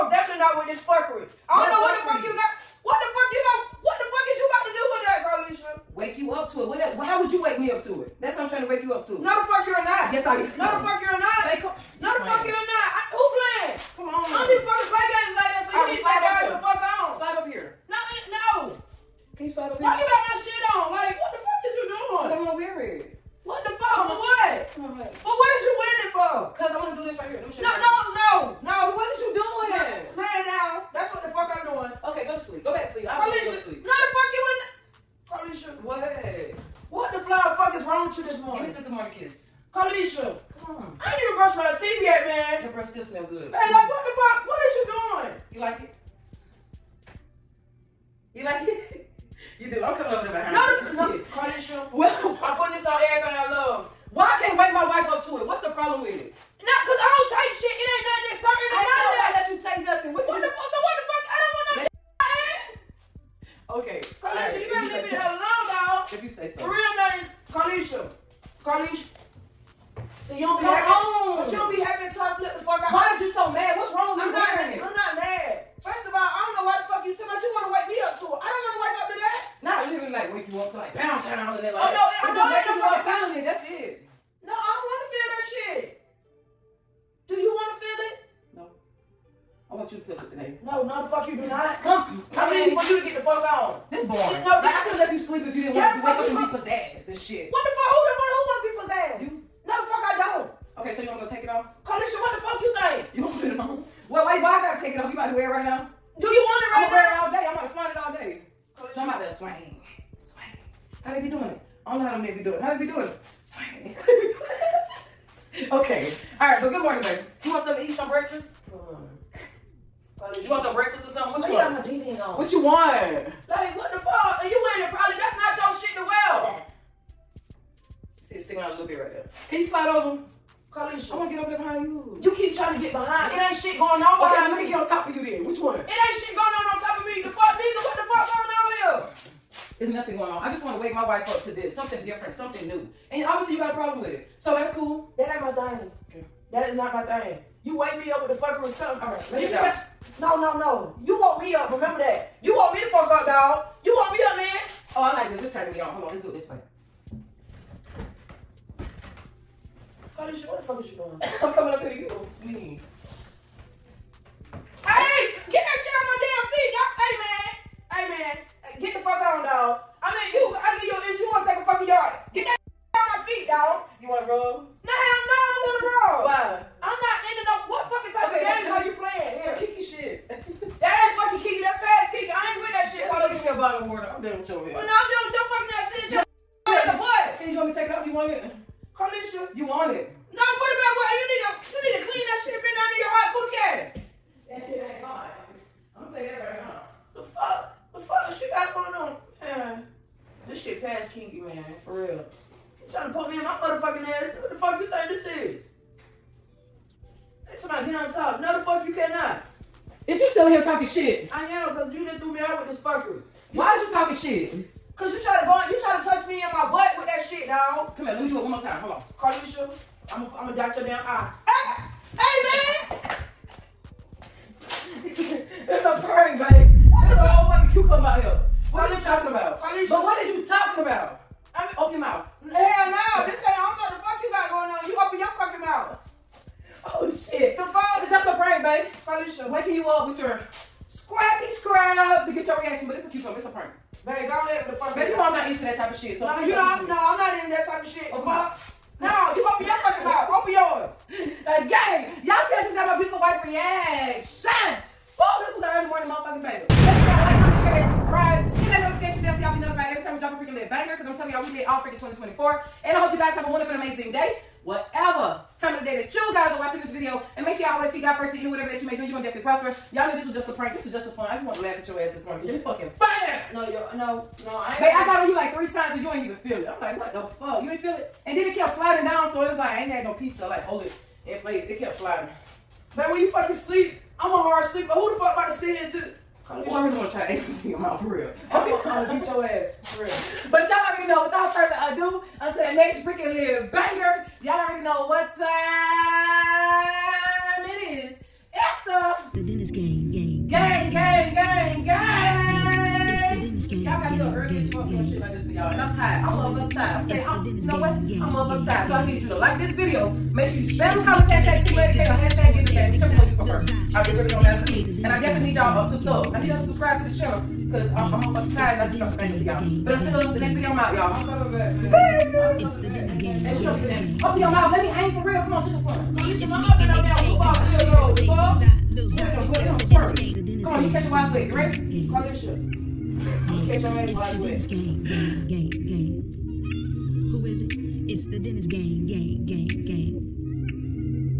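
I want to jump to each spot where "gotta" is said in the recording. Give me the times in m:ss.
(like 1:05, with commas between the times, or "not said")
1:04, 1:44, 5:04.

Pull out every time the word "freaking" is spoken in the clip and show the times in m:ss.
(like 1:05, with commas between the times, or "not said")
4:21, 4:53.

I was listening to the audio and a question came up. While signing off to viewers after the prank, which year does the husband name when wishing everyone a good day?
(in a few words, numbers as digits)
2024.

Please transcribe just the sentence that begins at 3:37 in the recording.
Come here, let me do it one more time.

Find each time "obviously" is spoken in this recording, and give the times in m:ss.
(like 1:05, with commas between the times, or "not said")
2:23.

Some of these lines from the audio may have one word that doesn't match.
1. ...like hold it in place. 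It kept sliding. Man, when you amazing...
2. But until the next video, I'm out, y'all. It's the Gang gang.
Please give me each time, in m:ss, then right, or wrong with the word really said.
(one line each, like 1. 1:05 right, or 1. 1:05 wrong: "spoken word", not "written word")
1. 4:40 wrong: "fucking", not "amazing"
2. 5:19 wrong: "Dennis", not "Gang".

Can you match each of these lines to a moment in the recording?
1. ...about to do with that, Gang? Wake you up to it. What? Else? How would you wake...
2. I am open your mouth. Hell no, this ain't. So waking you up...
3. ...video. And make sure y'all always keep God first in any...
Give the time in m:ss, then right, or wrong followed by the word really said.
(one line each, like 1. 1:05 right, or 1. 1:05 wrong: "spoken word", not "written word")
1. 0:04 wrong: "Carlisha", not "Gang"
2. 3:51 right
3. 4:26 right.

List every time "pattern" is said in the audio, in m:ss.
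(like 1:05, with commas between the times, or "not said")
not said.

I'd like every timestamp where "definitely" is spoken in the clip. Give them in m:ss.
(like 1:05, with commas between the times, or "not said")
4:29, 5:15.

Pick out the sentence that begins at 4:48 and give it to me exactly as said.
I'm gonna beat your ass for real.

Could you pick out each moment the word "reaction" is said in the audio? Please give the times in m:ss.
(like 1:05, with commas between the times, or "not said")
4:02, 4:13.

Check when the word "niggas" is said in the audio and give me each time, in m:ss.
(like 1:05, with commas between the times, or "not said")
1:52, 2:17.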